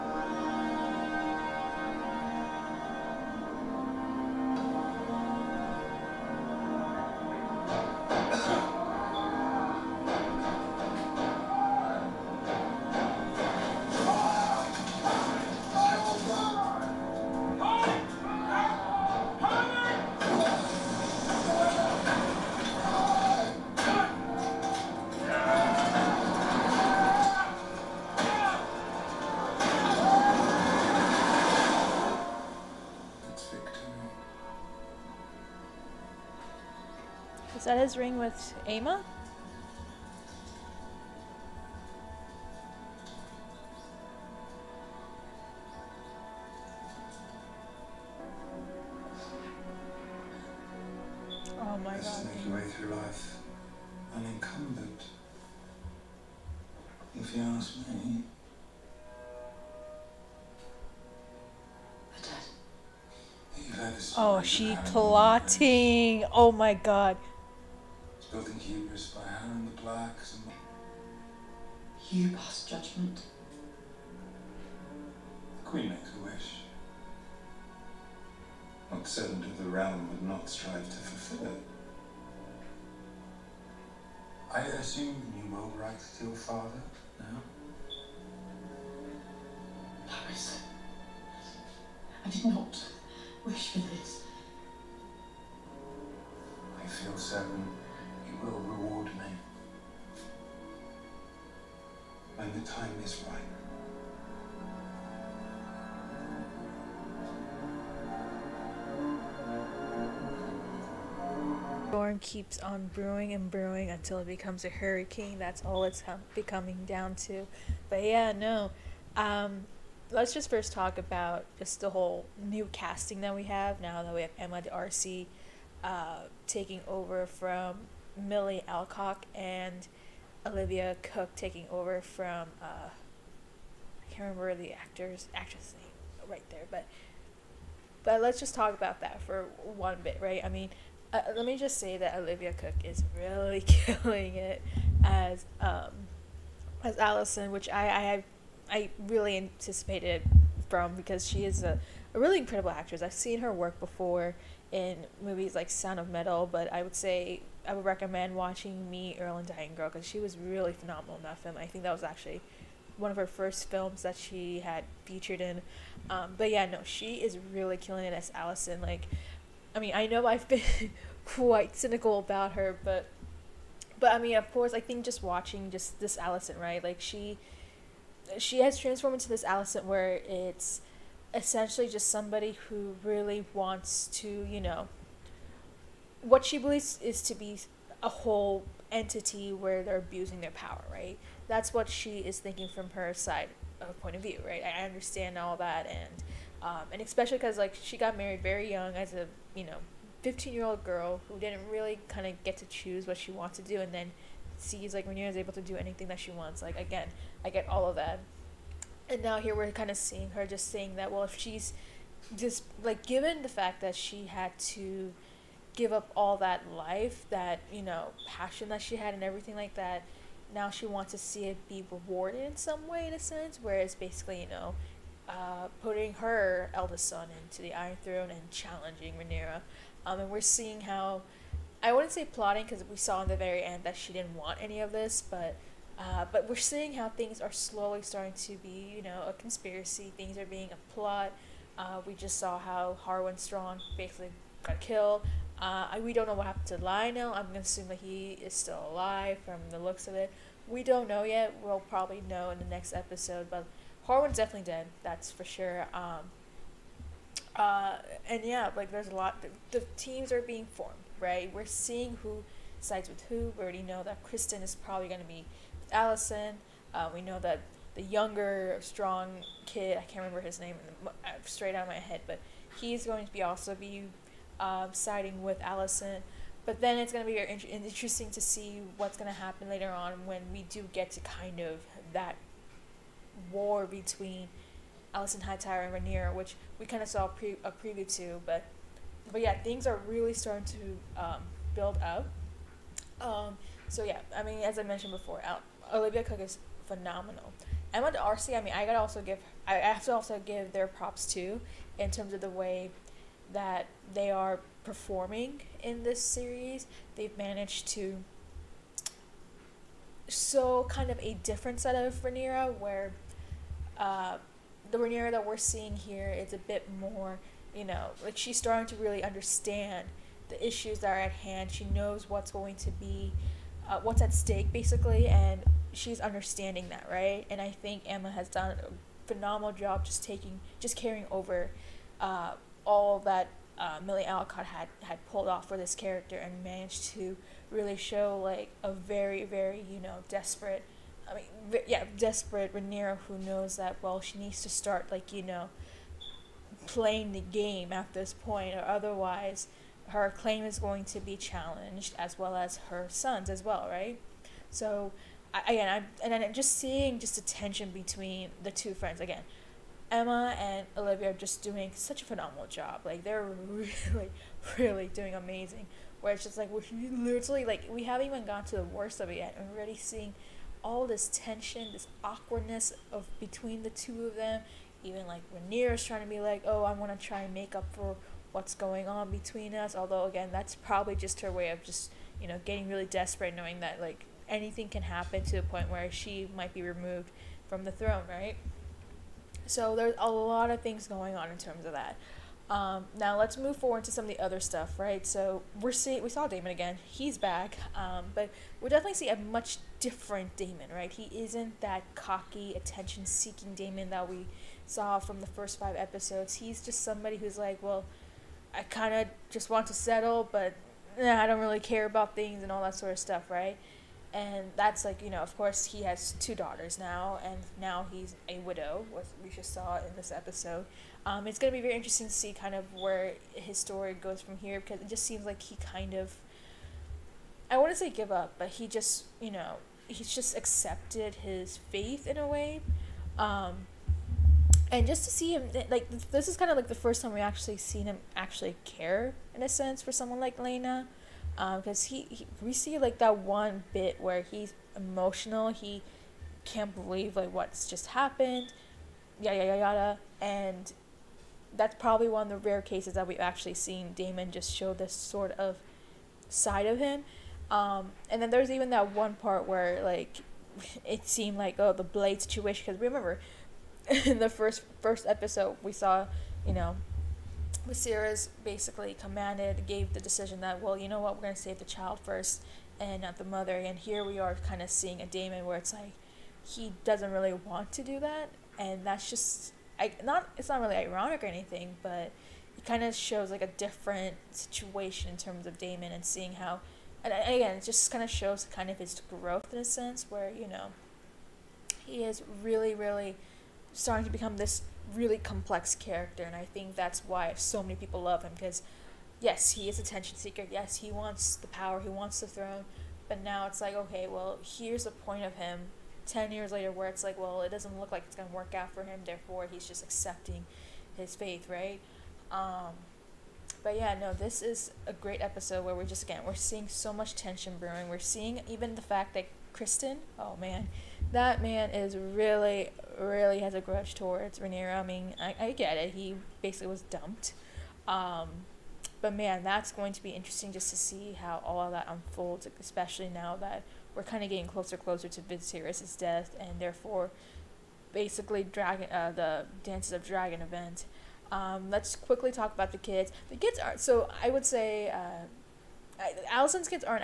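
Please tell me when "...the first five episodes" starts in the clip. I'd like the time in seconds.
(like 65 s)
405 s.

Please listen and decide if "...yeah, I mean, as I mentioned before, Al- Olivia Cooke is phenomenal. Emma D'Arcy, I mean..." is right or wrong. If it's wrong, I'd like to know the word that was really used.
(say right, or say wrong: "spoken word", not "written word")
right.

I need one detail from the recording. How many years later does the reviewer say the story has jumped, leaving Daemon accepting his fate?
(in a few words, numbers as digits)
10.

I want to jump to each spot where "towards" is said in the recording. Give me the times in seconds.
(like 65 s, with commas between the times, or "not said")
524 s.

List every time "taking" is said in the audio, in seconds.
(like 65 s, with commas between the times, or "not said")
126 s, 131 s, 330 s.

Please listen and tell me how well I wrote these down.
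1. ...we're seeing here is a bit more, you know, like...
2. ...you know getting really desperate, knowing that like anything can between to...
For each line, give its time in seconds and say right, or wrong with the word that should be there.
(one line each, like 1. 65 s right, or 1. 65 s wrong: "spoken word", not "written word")
1. 315 s right
2. 382 s wrong: "happen", not "between".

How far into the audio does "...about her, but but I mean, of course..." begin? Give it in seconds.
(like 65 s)
172 s.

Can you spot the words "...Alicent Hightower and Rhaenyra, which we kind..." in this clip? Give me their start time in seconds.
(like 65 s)
285 s.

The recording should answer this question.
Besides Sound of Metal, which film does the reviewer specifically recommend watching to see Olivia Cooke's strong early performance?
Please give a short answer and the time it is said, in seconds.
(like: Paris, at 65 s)
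Me, Earl, and Dying Girl, at 158 s.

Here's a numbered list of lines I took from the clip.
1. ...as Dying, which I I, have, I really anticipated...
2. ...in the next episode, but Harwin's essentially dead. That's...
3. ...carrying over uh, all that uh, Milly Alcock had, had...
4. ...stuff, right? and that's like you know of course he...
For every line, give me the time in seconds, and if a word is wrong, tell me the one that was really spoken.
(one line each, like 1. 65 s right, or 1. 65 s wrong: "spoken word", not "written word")
1. 146 s wrong: "Alicent", not "Dying"
2. 252 s wrong: "definitely", not "essentially"
3. 330 s right
4. 413 s right.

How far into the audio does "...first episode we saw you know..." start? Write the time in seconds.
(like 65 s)
465 s.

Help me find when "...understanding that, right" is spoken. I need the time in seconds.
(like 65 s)
326 s.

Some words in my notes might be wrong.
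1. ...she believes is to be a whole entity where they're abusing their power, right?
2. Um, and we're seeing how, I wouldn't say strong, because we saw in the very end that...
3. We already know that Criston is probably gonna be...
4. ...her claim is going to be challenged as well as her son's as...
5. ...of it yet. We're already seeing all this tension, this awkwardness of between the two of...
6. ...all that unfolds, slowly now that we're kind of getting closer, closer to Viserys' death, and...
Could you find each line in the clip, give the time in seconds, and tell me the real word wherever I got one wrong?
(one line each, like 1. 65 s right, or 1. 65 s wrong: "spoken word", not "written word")
1. 186 s right
2. 230 s wrong: "plotting", not "strong"
3. 263 s right
4. 350 s right
5. 369 s right
6. 531 s wrong: "especially", not "slowly".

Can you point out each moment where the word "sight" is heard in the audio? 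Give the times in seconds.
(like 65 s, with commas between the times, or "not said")
not said.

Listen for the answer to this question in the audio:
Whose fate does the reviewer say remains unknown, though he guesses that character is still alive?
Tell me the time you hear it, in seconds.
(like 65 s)
246 s.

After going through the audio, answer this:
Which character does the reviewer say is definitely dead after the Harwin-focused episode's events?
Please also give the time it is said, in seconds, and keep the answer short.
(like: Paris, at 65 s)
Harwin Strong, at 243 s.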